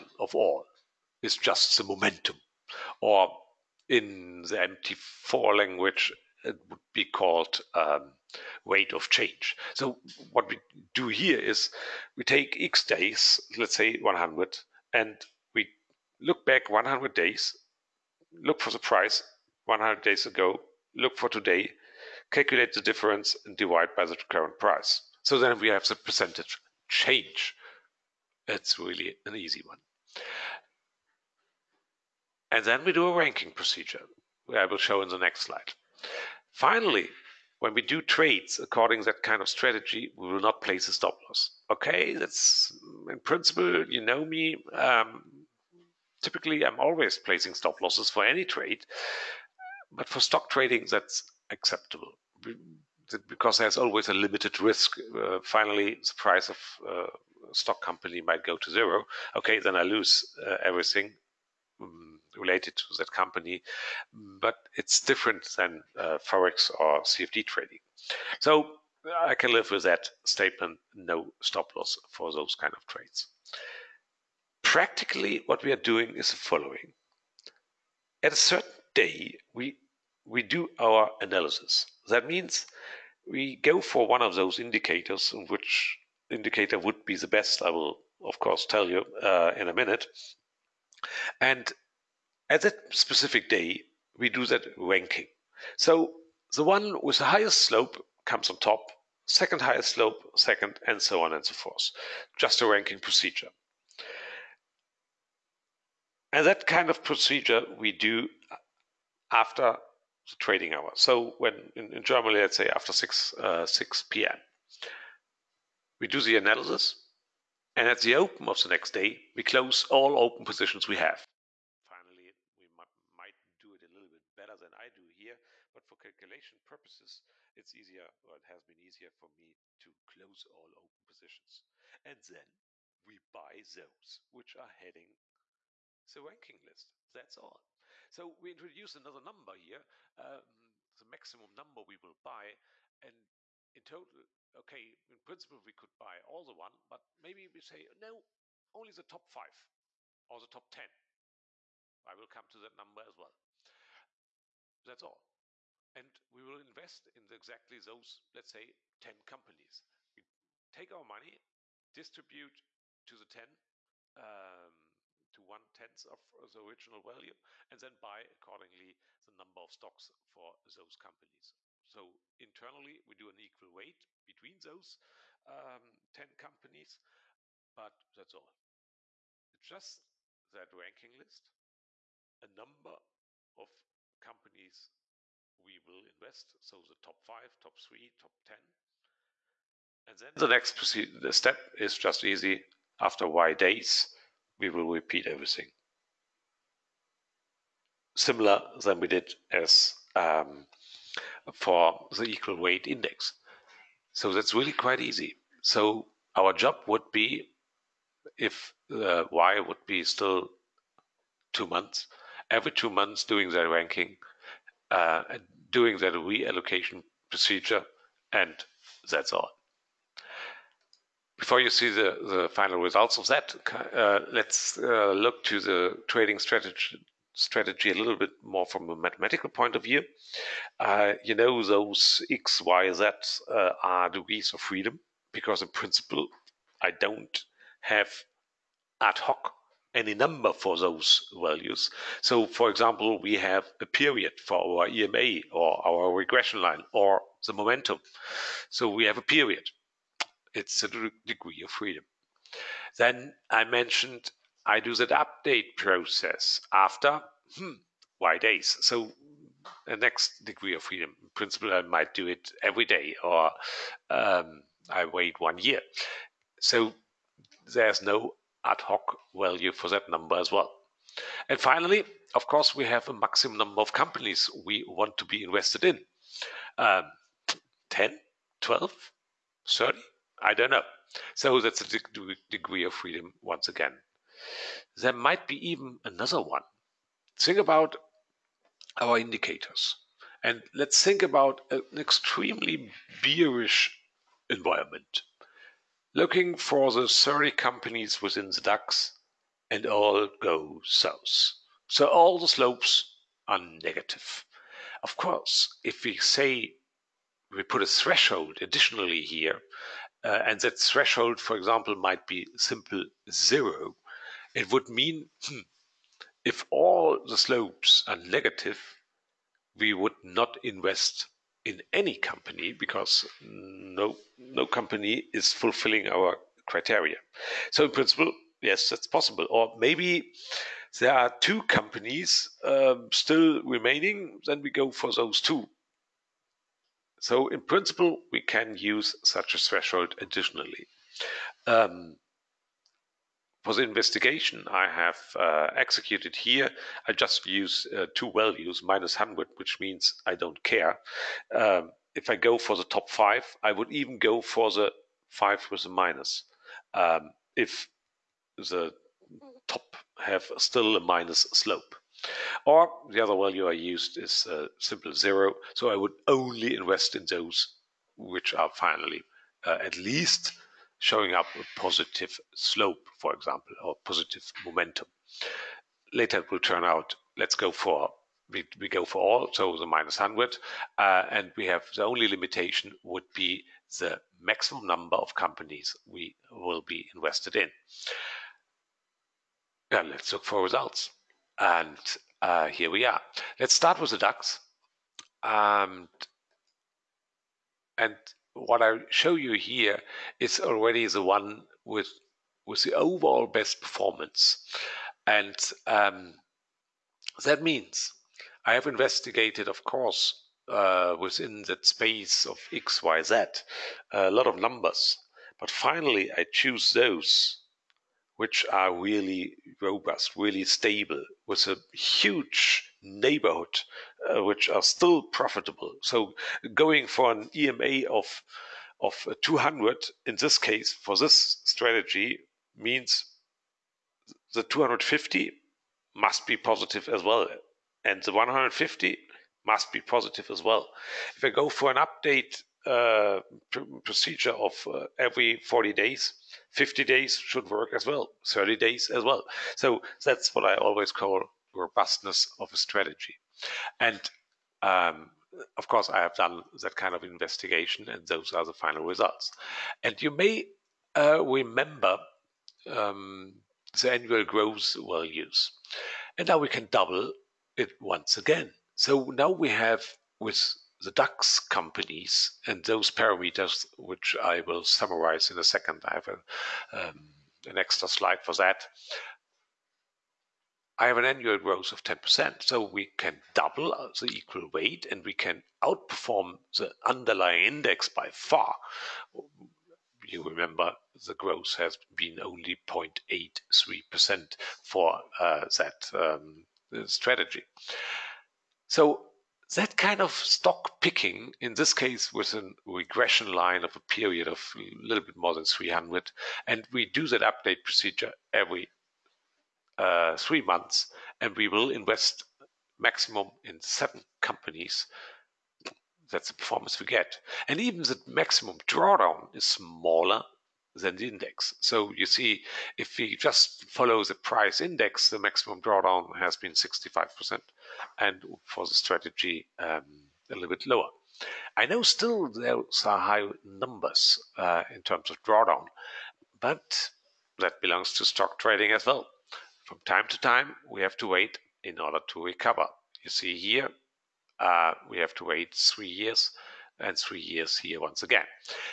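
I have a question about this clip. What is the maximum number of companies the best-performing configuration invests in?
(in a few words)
7.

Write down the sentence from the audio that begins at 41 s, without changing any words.
Okay, that's in principle, you know me.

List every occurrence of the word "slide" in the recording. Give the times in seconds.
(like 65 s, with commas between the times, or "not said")
35 s, 478 s.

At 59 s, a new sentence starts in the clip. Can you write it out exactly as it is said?
Okay, then I lose uh, everything mm, related to that company, but it's different than uh, forex or CFD trading.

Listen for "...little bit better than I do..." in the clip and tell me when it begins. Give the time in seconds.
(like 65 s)
123 s.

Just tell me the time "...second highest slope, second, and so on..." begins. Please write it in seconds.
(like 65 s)
99 s.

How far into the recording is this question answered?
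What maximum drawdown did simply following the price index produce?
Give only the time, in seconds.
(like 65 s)
526 s.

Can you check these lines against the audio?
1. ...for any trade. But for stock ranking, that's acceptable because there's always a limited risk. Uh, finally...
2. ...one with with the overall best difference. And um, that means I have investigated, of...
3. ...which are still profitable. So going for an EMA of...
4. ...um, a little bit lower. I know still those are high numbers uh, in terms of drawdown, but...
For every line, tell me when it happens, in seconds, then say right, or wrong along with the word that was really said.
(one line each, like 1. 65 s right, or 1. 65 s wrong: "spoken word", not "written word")
1. 48 s wrong: "trading", not "ranking"
2. 401 s wrong: "performance", not "difference"
3. 424 s right
4. 529 s right.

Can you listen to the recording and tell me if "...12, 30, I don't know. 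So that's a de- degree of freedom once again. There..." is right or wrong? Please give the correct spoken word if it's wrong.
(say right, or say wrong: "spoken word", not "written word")
right.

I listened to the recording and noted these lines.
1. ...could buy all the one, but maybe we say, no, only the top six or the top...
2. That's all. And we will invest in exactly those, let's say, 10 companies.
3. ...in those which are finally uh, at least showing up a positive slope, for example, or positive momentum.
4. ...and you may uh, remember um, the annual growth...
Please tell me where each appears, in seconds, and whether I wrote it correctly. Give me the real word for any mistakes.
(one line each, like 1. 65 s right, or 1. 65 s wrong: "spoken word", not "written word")
1. 145 s wrong: "five", not "six"
2. 154 s right
3. 367 s right
4. 460 s right.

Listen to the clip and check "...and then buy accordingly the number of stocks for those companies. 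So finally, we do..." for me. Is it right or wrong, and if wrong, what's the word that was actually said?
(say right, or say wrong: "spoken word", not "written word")
wrong: "internally", not "finally".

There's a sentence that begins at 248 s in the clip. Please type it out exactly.
So we have a period it's a degree of freedom.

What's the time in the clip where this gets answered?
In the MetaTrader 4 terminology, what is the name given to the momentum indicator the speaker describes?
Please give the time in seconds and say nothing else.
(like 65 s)
8 s.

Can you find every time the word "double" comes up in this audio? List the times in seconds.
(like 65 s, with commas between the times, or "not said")
466 s, 483 s.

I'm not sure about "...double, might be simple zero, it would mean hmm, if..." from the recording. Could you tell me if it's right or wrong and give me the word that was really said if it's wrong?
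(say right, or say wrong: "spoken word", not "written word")
wrong: "example", not "double".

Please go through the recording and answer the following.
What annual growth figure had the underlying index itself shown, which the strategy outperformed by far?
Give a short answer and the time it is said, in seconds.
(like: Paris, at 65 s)
0.83%, at 492 s.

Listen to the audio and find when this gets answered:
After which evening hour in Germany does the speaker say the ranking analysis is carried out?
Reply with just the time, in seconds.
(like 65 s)
113 s.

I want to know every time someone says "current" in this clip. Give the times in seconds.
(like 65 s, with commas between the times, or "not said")
24 s.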